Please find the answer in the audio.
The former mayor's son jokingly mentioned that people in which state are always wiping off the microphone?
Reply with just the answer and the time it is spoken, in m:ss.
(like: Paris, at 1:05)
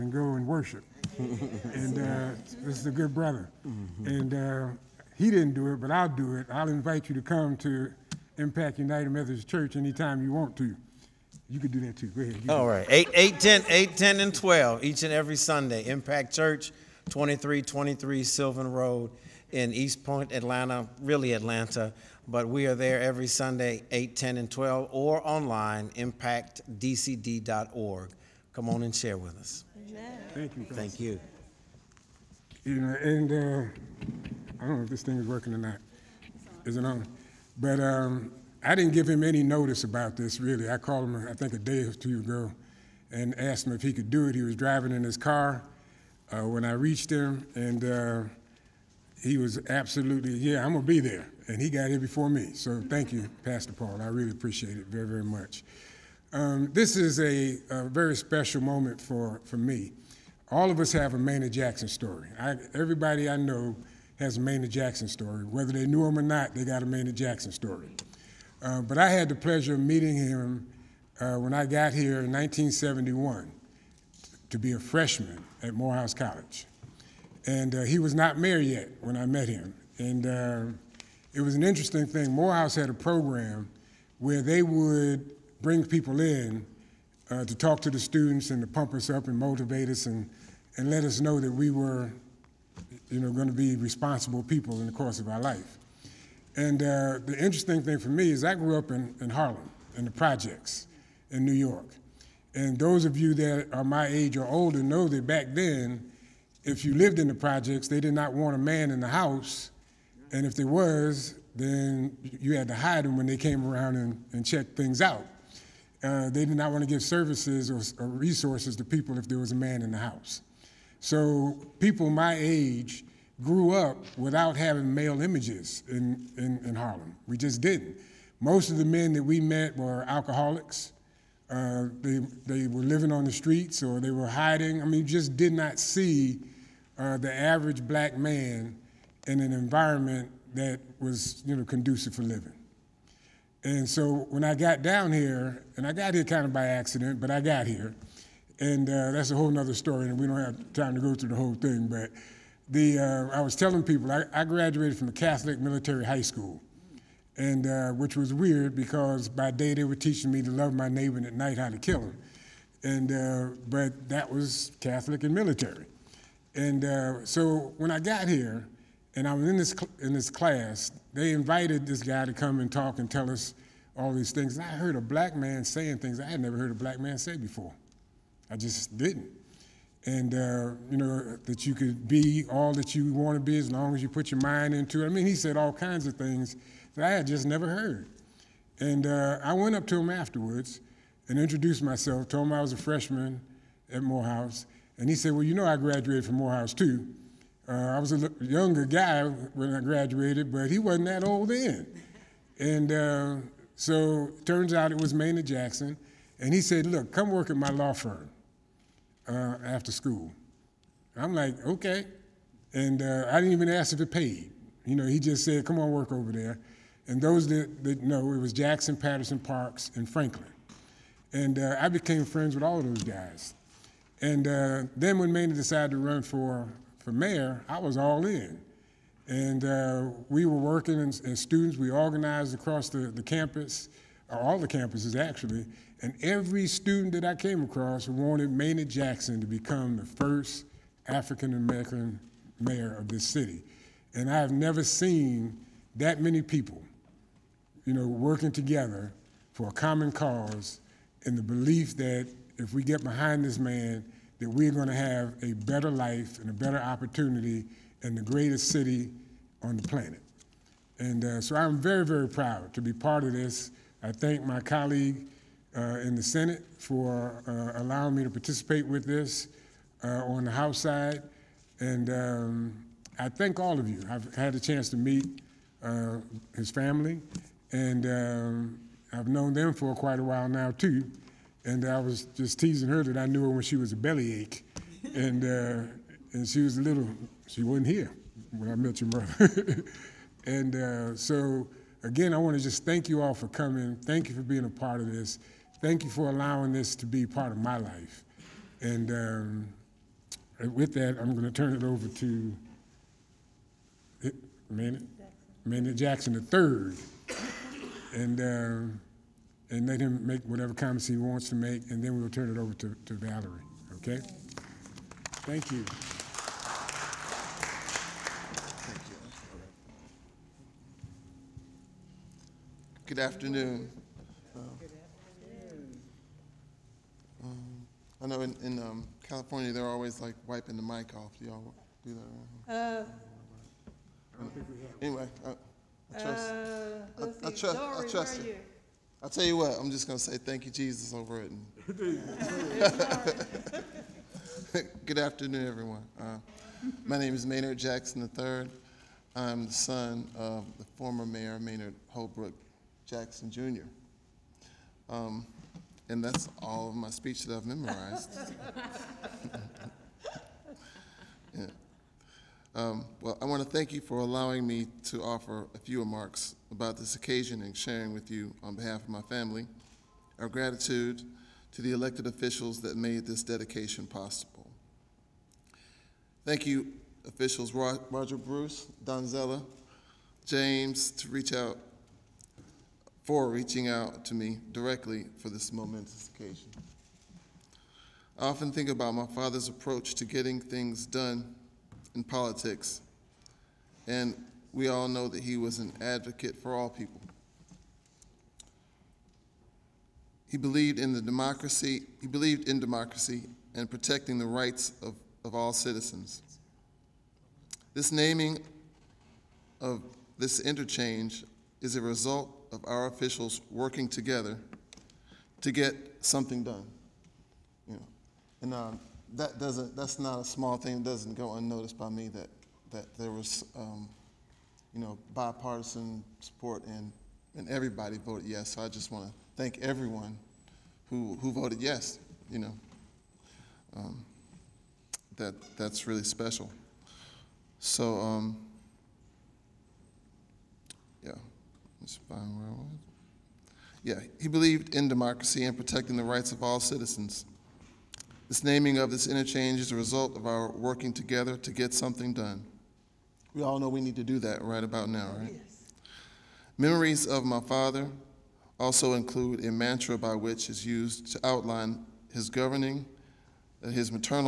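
California, at 5:29.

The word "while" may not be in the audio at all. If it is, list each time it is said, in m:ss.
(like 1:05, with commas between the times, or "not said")
4:40.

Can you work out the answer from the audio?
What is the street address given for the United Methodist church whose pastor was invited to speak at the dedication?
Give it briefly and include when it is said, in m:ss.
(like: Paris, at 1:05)
2323 Sylvan Road, at 0:17.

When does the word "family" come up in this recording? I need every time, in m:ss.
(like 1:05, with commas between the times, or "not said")
4:36, 6:09.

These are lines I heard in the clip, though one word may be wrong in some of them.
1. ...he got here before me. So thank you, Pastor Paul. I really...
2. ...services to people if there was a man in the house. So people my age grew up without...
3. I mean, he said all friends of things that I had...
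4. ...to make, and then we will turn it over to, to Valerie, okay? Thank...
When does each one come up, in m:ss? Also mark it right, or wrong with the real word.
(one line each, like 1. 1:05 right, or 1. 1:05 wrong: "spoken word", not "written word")
1. 0:51 right
2. 1:58 wrong: "resources", not "services"
3. 3:05 wrong: "kinds", not "friends"
4. 5:11 right.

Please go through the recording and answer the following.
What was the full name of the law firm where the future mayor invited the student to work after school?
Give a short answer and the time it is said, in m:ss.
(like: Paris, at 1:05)
Jackson, Patterson, Parks, and Franklin, at 3:38.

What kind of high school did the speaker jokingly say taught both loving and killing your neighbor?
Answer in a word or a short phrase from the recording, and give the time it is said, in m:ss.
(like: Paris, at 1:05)
Catholic military high school, at 2:35.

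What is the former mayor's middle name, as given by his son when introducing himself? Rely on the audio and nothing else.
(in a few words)
Holbrook.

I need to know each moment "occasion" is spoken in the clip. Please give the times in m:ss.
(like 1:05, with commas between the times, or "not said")
6:07, 6:26.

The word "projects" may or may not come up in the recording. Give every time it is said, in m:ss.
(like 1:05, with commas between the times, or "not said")
1:40, 1:47.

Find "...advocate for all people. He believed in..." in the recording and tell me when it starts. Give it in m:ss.
6:36.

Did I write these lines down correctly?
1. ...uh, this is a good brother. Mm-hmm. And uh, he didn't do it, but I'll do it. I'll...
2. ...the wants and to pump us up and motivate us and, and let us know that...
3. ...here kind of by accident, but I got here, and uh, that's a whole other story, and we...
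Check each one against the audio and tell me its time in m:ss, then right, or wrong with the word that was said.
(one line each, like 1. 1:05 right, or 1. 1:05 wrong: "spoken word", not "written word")
1. 0:01 right
2. 1:27 wrong: "students", not "wants"
3. 2:26 right.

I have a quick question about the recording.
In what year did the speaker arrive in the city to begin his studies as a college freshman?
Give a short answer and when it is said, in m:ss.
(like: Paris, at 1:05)
1971, at 1:12.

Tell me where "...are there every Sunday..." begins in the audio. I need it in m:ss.
0:22.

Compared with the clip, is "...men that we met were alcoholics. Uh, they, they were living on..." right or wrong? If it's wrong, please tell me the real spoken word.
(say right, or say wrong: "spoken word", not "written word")
right.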